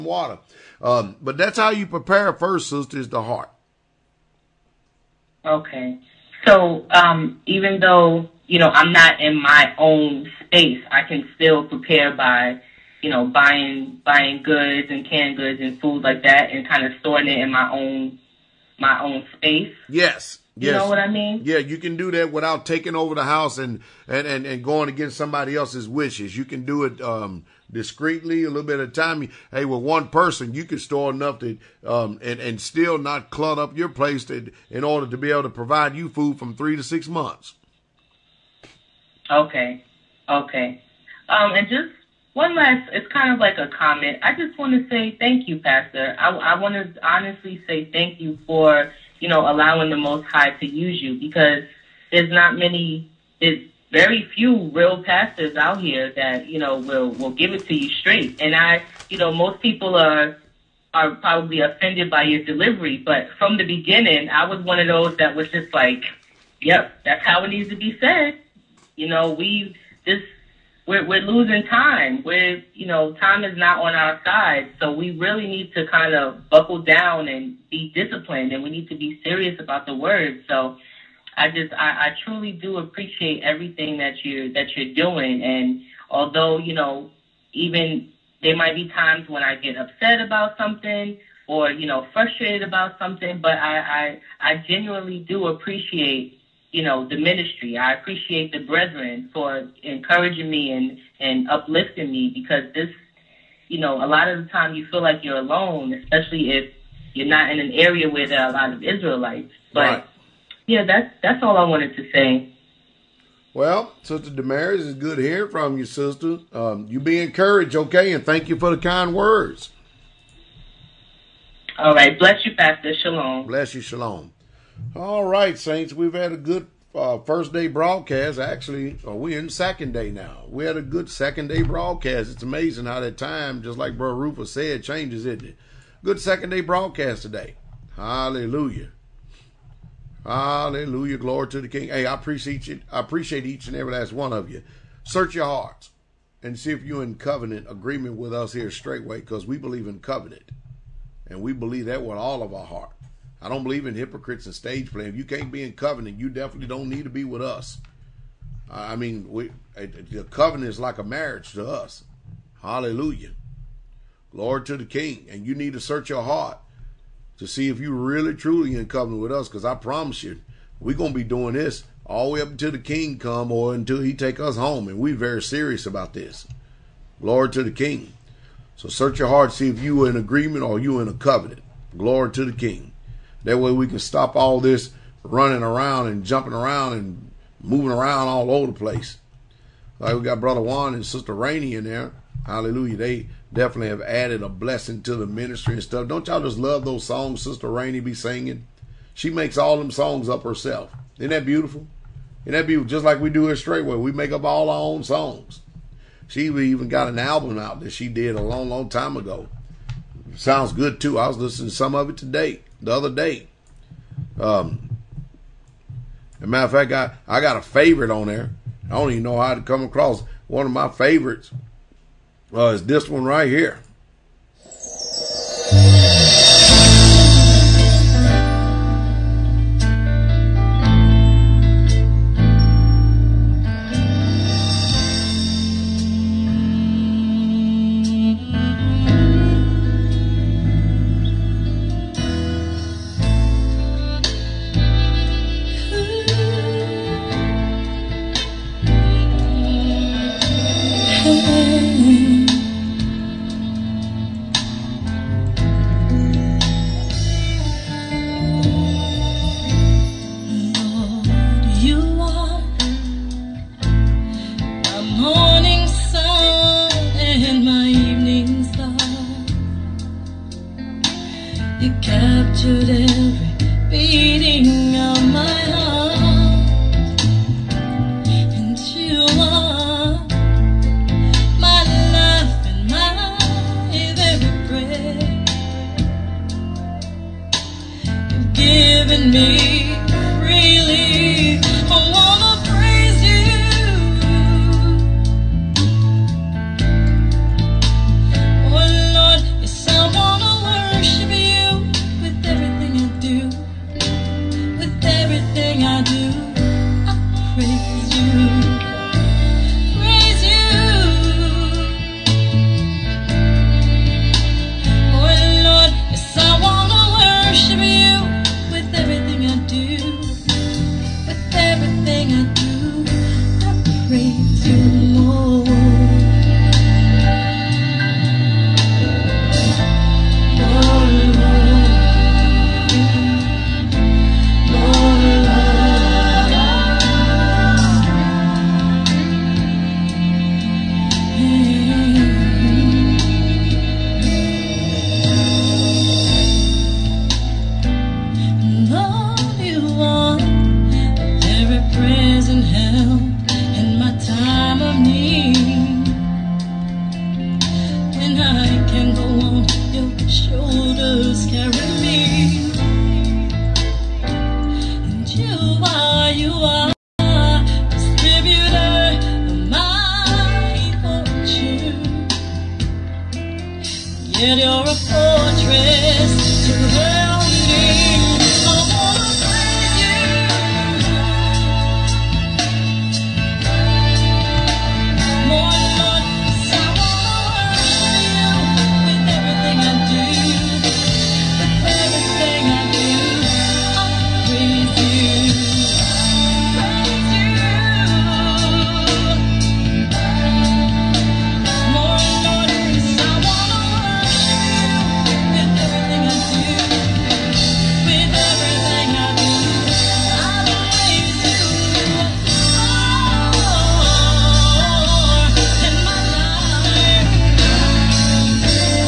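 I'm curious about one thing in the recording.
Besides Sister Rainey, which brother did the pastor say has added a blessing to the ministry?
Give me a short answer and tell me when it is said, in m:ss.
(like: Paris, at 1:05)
Juan, at 3:10.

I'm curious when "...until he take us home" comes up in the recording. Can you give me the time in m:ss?
2:53.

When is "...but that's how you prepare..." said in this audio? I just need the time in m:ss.
0:01.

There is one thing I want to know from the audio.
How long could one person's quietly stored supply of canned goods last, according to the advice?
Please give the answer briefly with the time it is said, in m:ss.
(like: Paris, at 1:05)
3 to 6 months, at 0:36.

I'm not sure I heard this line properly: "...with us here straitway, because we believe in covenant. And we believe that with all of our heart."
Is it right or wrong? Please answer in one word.
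right.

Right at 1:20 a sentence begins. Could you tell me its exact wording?
So I just, I, I truly do appreciate everything that you're, that you're doing.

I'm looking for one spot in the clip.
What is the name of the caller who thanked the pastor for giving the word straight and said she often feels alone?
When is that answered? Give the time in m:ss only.
1:54.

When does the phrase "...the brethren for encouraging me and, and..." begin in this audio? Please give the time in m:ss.
1:38.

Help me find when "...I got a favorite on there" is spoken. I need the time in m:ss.
3:37.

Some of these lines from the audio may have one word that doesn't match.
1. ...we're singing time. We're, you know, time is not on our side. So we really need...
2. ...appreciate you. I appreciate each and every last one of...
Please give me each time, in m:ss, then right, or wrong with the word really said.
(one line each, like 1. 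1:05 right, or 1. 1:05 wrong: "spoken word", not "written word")
1. 1:11 wrong: "losing", not "singing"
2. 2:22 right.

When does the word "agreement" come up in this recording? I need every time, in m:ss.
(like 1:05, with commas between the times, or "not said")
2:27, 3:00.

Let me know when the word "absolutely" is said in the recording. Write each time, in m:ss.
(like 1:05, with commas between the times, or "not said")
not said.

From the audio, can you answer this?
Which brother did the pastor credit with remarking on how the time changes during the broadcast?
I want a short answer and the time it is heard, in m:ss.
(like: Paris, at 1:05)
Rufus, at 2:14.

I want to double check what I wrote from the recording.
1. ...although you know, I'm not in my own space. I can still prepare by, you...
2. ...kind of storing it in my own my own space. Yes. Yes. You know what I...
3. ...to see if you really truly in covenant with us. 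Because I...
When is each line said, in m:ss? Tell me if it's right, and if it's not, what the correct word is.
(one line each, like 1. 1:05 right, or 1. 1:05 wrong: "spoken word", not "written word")
1. 0:07 wrong: "though", not "although"
2. 0:16 right
3. 2:47 right.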